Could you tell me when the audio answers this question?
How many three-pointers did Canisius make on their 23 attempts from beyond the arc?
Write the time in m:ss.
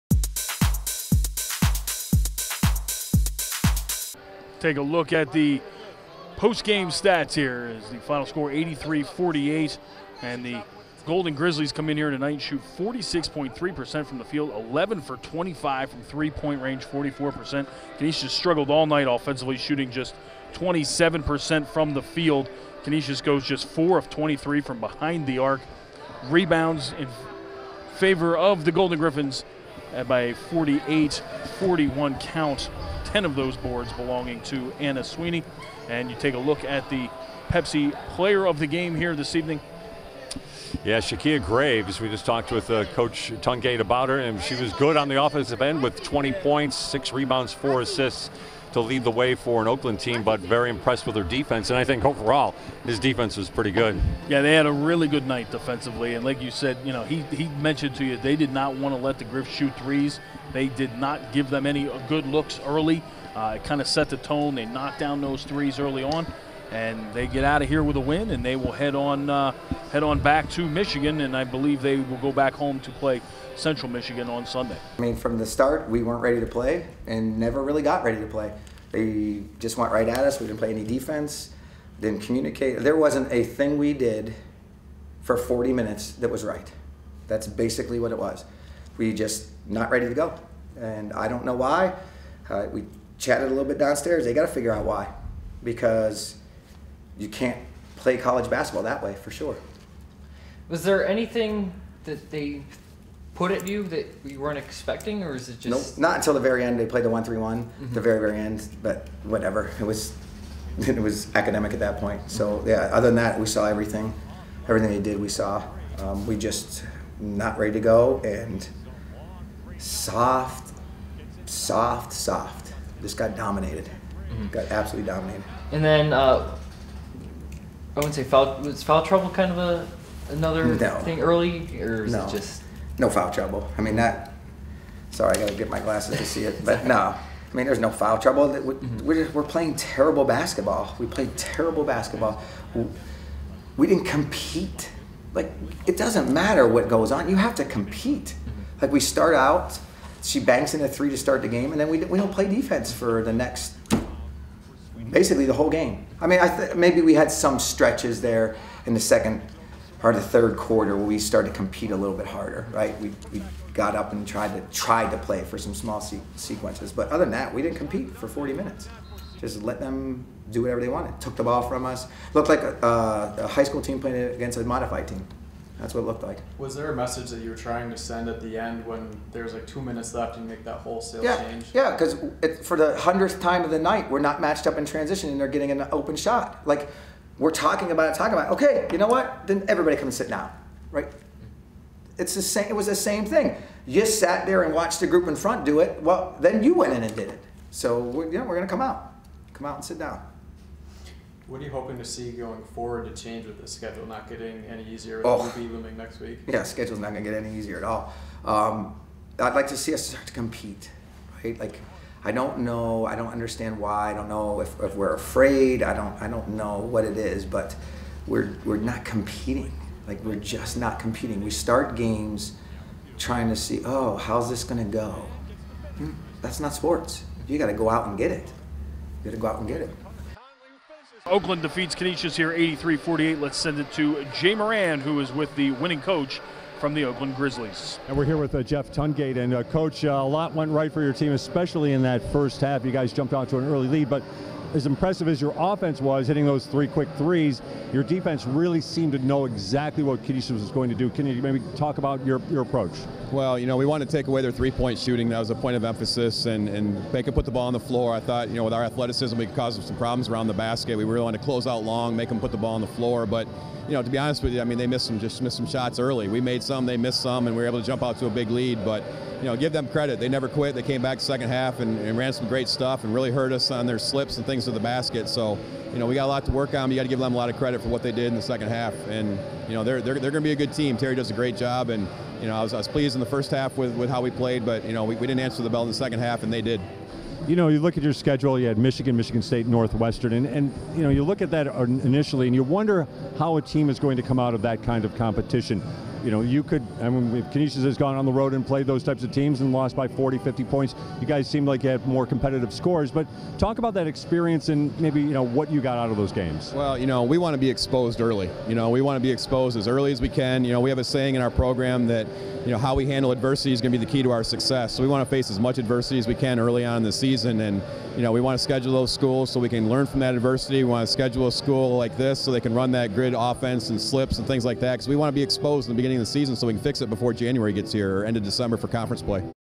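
0:23.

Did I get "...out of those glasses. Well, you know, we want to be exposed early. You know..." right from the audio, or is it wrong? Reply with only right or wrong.
wrong.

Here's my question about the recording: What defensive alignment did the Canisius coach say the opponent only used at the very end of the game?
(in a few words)
1-3-1.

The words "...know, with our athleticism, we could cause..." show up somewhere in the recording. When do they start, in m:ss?
4:18.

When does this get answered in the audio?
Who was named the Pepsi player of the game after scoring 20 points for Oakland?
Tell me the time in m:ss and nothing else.
0:40.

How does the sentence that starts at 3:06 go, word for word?
Like we're talking about it, talking about it.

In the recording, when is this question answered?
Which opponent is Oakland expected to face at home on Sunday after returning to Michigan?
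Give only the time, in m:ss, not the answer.
1:13.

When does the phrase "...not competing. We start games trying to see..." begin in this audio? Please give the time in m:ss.
3:40.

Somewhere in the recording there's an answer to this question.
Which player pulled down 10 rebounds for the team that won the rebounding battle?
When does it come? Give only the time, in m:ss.
0:34.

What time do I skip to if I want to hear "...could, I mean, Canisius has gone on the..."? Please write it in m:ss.
4:56.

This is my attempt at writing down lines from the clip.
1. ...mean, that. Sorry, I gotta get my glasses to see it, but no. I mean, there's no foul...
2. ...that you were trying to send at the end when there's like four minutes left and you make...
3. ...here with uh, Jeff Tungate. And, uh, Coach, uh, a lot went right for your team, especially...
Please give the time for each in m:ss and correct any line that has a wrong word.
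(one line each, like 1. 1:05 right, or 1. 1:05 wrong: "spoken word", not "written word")
1. 2:13 right
2. 2:57 wrong: "two", not "four"
3. 3:58 right.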